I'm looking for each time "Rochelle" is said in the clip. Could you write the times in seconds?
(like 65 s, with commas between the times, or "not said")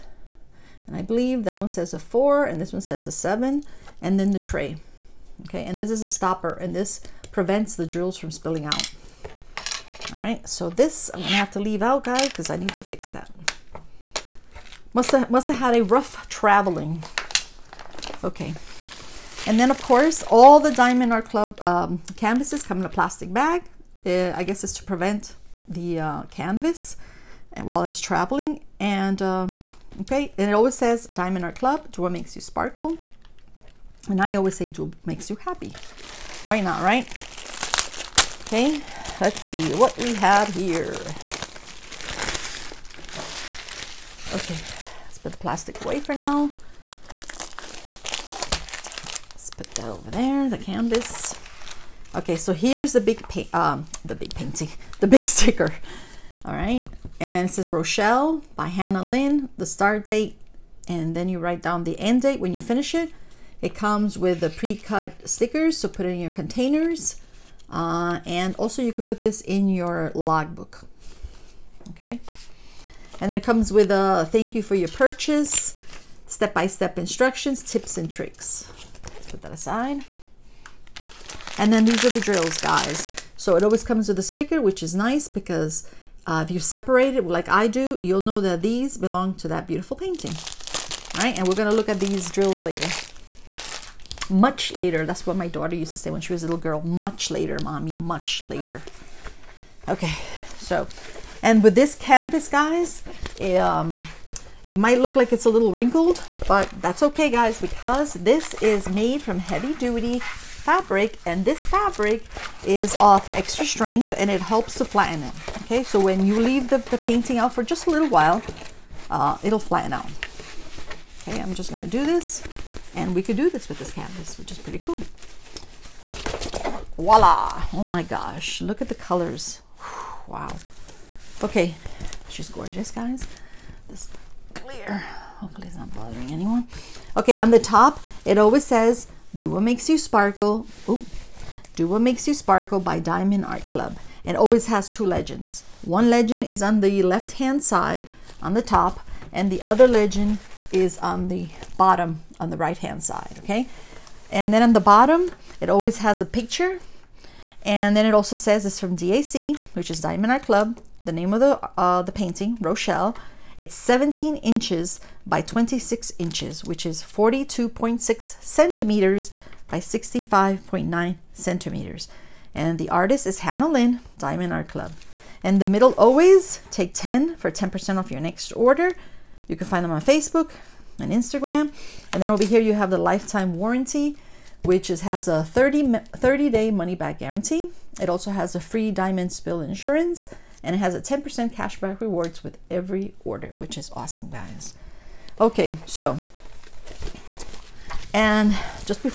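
57 s, 162 s.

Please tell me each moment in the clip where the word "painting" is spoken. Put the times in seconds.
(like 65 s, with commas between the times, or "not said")
54 s, 89 s, 116 s, 162 s.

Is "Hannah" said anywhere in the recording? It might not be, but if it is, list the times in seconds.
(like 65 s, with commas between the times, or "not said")
58 s, 173 s.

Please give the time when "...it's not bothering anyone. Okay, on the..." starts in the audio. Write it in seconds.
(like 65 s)
135 s.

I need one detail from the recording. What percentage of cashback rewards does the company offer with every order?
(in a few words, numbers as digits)
10%.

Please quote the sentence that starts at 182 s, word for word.
And then over here, you have the lifetime warranty, which is, has a 30, 30 day money back guarantee.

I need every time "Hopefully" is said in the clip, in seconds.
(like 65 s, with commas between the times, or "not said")
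135 s.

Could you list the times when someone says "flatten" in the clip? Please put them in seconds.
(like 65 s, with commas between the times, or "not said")
114 s, 119 s.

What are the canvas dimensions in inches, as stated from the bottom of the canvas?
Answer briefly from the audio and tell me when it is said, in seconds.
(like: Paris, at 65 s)
17 by 26 inches, at 163 s.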